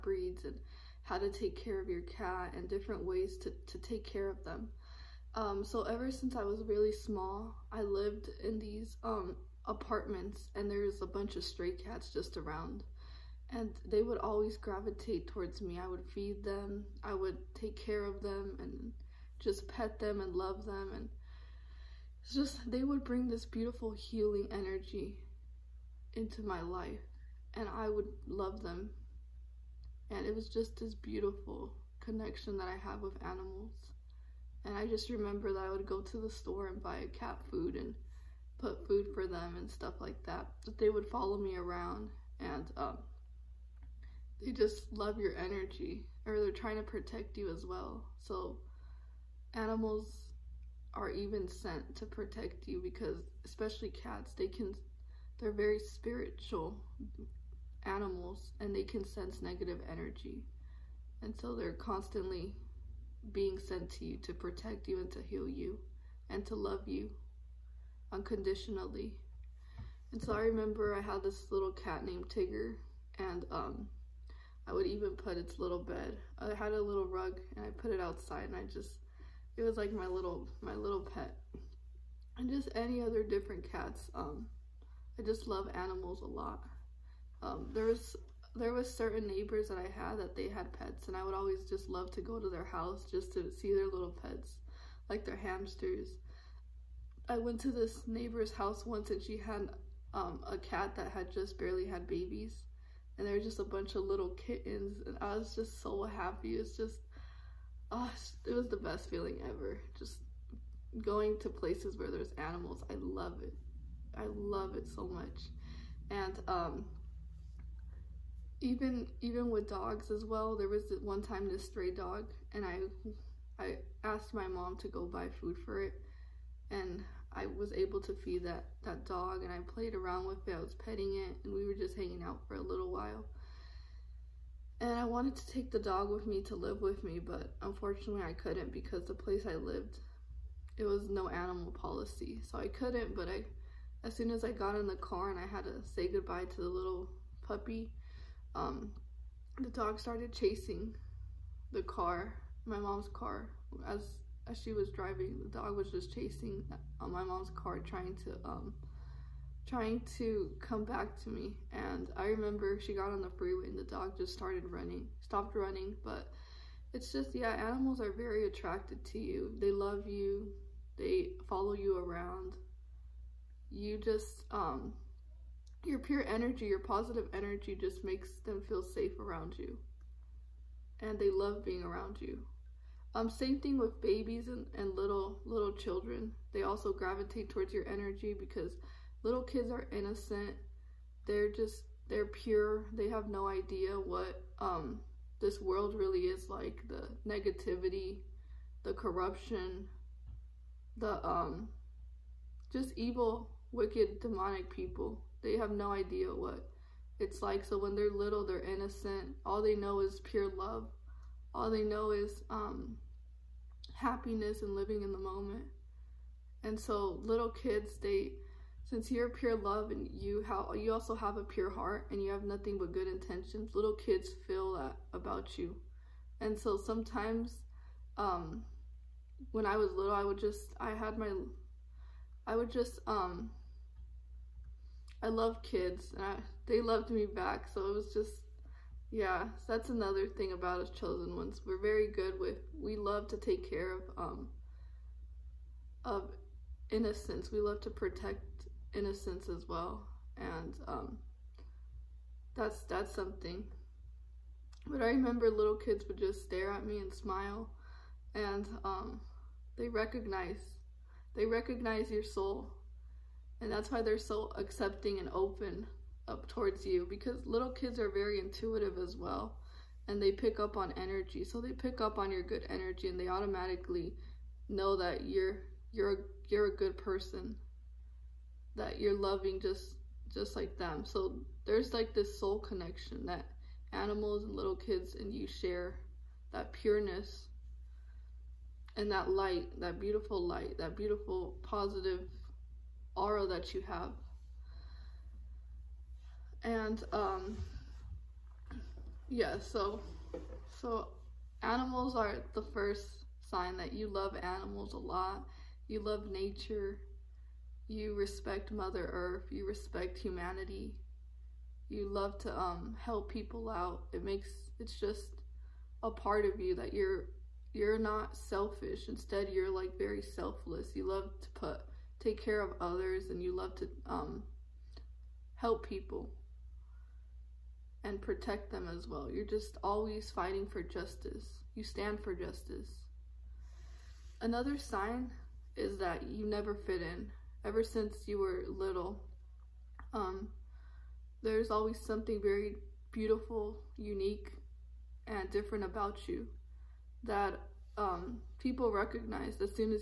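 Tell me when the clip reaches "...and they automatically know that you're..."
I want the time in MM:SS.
04:33.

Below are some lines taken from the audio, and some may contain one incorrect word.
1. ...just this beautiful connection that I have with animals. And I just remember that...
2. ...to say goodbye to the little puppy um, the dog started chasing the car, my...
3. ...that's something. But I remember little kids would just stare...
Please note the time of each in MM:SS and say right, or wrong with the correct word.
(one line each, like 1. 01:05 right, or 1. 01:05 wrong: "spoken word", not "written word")
1. 00:30 right
2. 02:25 right
3. 04:12 right.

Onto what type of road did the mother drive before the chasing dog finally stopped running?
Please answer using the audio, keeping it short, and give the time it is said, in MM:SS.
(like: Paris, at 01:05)
Freeway, at 02:43.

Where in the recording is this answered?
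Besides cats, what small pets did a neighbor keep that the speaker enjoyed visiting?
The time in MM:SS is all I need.
01:35.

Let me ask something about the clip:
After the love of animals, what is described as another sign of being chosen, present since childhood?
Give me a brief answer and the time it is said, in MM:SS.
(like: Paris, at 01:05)
Never fit in, at 05:36.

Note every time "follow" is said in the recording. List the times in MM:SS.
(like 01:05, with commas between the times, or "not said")
00:41, 02:51.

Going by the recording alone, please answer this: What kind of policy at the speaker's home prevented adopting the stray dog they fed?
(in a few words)
No animal policy.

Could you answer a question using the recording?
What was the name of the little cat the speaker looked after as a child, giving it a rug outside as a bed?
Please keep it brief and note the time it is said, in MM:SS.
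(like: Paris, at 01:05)
Tigger, at 01:12.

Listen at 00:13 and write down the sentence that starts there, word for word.
And they would always gravitate towards me.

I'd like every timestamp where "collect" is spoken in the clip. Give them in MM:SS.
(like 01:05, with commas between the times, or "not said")
not said.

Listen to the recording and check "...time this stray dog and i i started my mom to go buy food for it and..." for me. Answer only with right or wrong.
wrong.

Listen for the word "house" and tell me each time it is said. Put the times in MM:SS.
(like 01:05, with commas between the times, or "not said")
01:32, 01:38.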